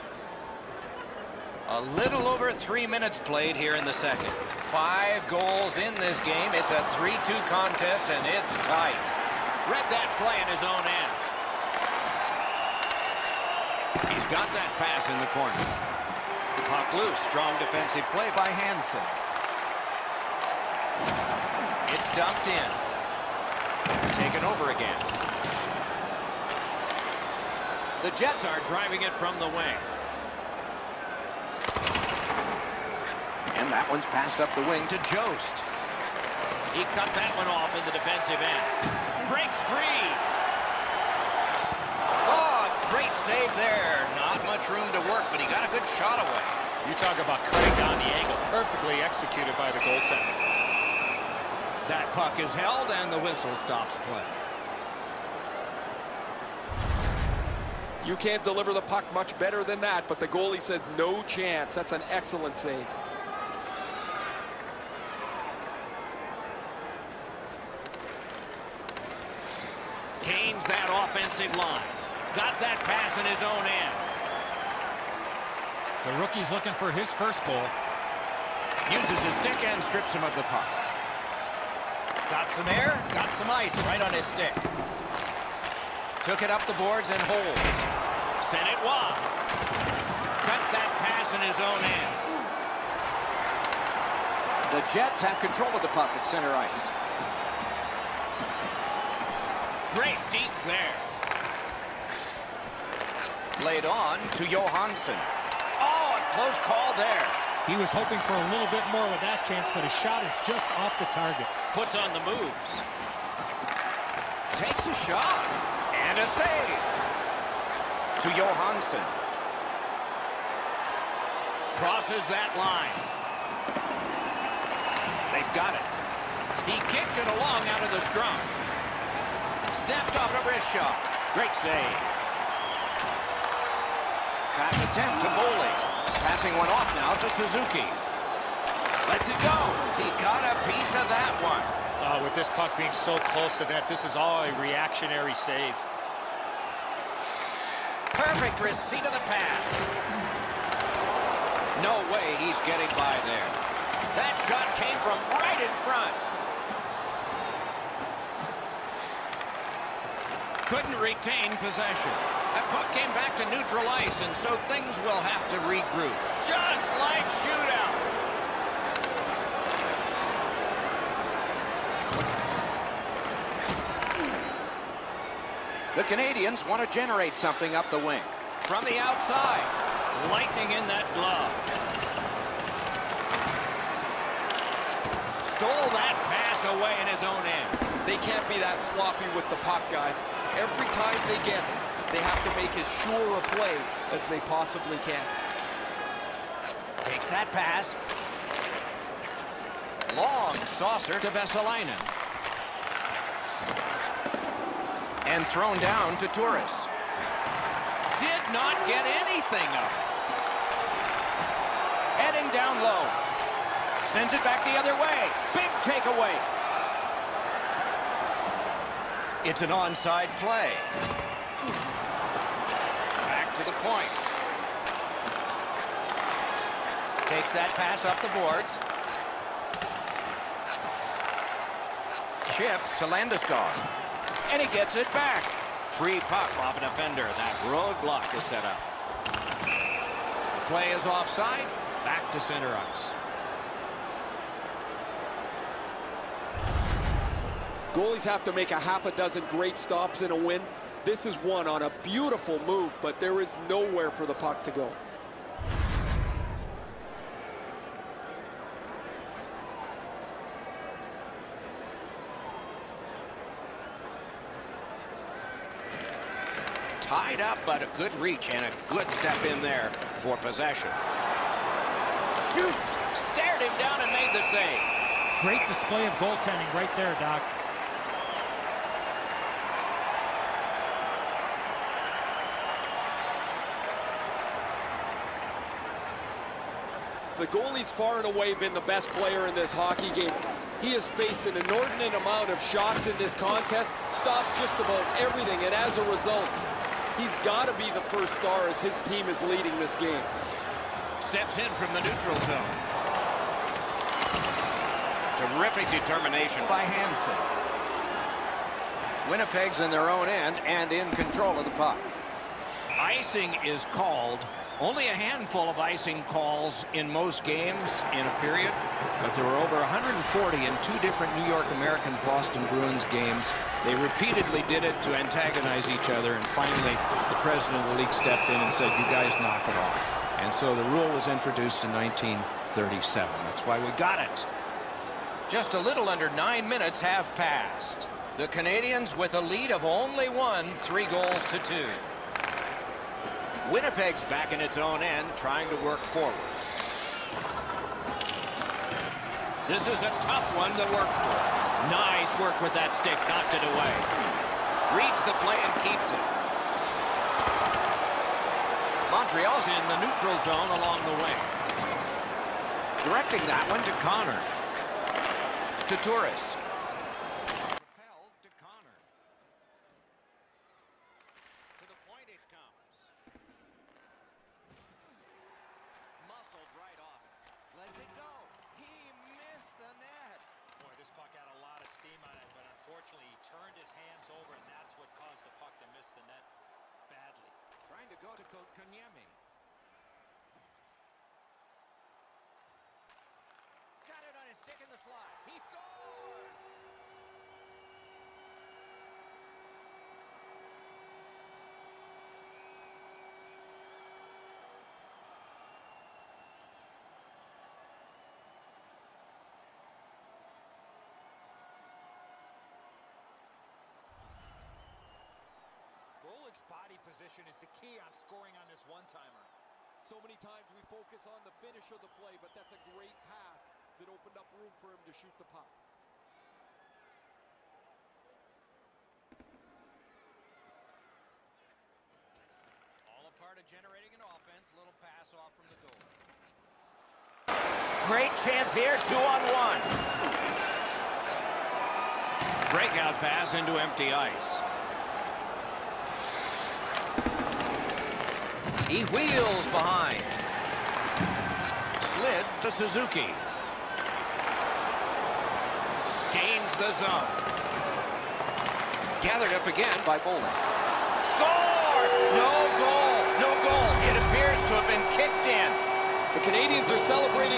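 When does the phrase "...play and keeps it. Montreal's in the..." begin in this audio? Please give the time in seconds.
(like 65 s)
355 s.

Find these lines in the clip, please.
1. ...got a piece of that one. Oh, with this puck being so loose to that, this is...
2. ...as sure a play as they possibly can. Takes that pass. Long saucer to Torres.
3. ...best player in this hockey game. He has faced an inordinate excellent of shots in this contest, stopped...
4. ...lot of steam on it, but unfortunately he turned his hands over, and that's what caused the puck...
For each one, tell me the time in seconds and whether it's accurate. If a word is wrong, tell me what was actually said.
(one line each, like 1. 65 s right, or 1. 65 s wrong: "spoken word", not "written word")
1. 140 s wrong: "close", not "loose"
2. 192 s wrong: "Vesalainen", not "Torres"
3. 288 s wrong: "amount", not "excellent"
4. 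381 s right.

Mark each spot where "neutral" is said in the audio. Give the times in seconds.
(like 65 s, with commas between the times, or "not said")
163 s, 301 s, 360 s.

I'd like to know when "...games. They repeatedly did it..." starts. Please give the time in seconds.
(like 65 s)
323 s.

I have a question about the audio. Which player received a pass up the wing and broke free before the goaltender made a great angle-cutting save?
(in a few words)
Jost.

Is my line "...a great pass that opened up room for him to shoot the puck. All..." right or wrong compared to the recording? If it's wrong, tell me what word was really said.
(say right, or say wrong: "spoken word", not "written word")
right.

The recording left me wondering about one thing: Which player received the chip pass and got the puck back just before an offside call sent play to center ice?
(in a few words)
Landeskog.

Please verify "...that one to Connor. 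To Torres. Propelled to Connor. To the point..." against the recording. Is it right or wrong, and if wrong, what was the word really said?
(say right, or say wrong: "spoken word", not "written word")
right.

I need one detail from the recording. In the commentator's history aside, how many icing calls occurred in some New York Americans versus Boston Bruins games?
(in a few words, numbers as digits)
140.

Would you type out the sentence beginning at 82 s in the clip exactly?
Got some air, got some ice right on his stick.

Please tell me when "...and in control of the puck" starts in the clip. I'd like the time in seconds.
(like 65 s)
310 s.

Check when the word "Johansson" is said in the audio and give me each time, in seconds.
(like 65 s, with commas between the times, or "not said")
104 s, 118 s.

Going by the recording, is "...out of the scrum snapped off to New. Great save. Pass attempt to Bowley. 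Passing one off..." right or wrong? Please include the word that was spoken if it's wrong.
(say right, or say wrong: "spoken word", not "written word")
wrong: "Brishaw", not "New".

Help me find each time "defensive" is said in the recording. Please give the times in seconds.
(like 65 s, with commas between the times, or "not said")
17 s, 37 s.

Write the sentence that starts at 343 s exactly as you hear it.
Winnipeg's back in its own end, trying to work forward.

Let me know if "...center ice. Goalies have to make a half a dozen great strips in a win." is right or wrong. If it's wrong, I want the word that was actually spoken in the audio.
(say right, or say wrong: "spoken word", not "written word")
wrong: "stops", not "strips".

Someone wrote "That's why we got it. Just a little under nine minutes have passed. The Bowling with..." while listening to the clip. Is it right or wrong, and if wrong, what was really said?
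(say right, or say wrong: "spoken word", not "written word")
wrong: "Canadiens", not "Bowling".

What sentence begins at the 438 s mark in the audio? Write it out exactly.
Great chance here, two on one.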